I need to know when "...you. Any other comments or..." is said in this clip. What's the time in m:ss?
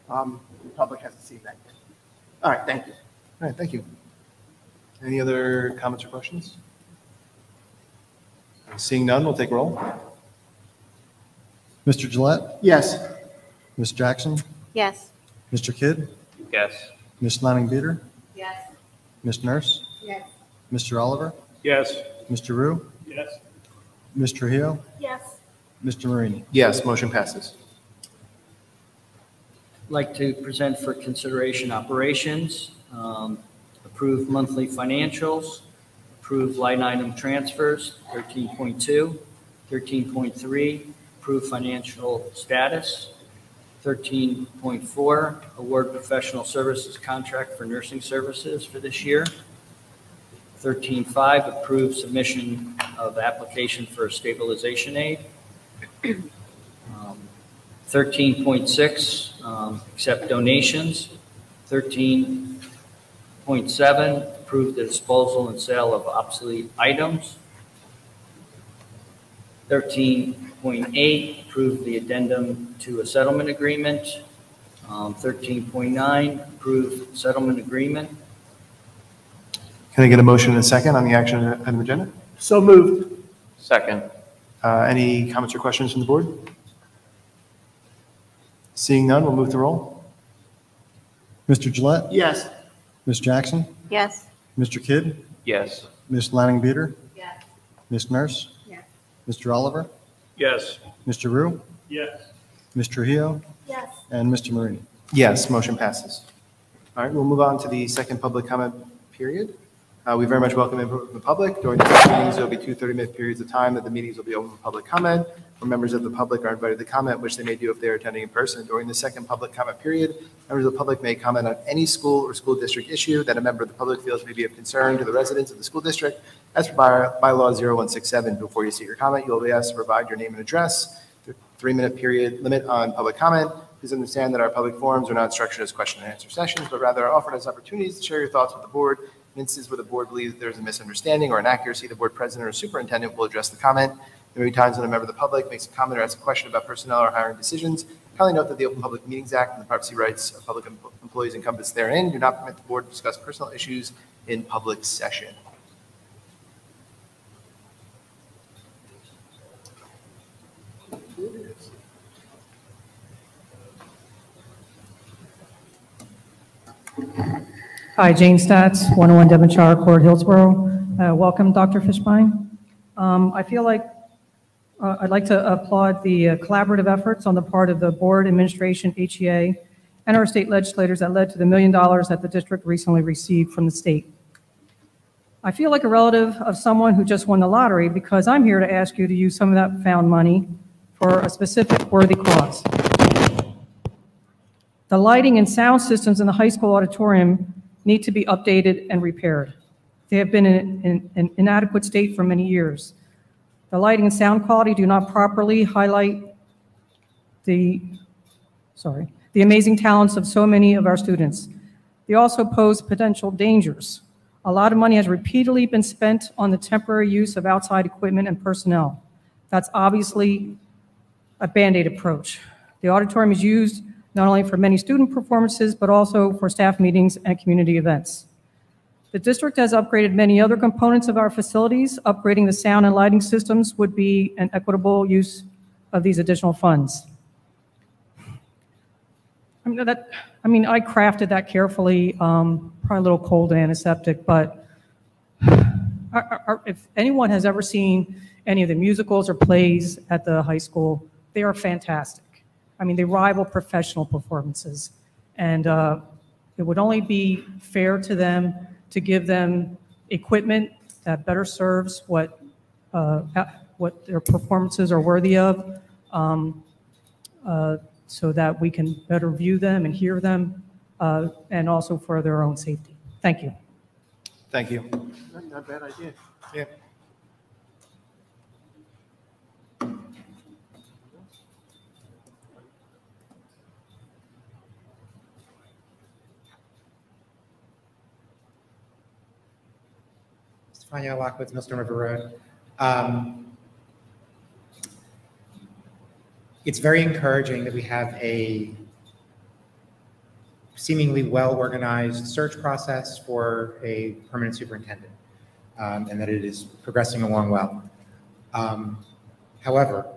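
0:03.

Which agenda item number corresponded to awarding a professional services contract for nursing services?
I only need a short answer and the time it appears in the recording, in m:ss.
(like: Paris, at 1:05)
13.4, at 0:43.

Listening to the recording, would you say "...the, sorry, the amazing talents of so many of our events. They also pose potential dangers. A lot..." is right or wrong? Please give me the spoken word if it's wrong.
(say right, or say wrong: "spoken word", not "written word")
wrong: "students", not "events".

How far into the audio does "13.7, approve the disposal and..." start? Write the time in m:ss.
1:01.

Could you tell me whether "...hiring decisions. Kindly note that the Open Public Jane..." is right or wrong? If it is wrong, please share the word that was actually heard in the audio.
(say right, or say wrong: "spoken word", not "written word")
wrong: "Meetings", not "Jane".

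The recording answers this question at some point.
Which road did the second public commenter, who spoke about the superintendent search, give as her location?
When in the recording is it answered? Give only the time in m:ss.
4:51.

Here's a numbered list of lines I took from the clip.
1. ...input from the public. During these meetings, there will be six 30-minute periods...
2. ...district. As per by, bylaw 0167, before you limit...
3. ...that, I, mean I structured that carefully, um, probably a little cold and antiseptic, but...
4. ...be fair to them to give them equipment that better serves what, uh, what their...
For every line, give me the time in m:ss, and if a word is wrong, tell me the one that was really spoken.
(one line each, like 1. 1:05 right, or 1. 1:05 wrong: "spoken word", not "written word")
1. 1:50 wrong: "two", not "six"
2. 2:05 wrong: "submit", not "limit"
3. 3:59 wrong: "crafted", not "structured"
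4. 4:16 right.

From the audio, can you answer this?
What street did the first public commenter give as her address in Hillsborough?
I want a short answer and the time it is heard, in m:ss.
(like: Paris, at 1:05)
Devonshire Court, at 2:49.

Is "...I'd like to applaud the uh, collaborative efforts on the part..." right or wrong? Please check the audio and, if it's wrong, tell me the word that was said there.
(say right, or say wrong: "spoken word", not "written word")
right.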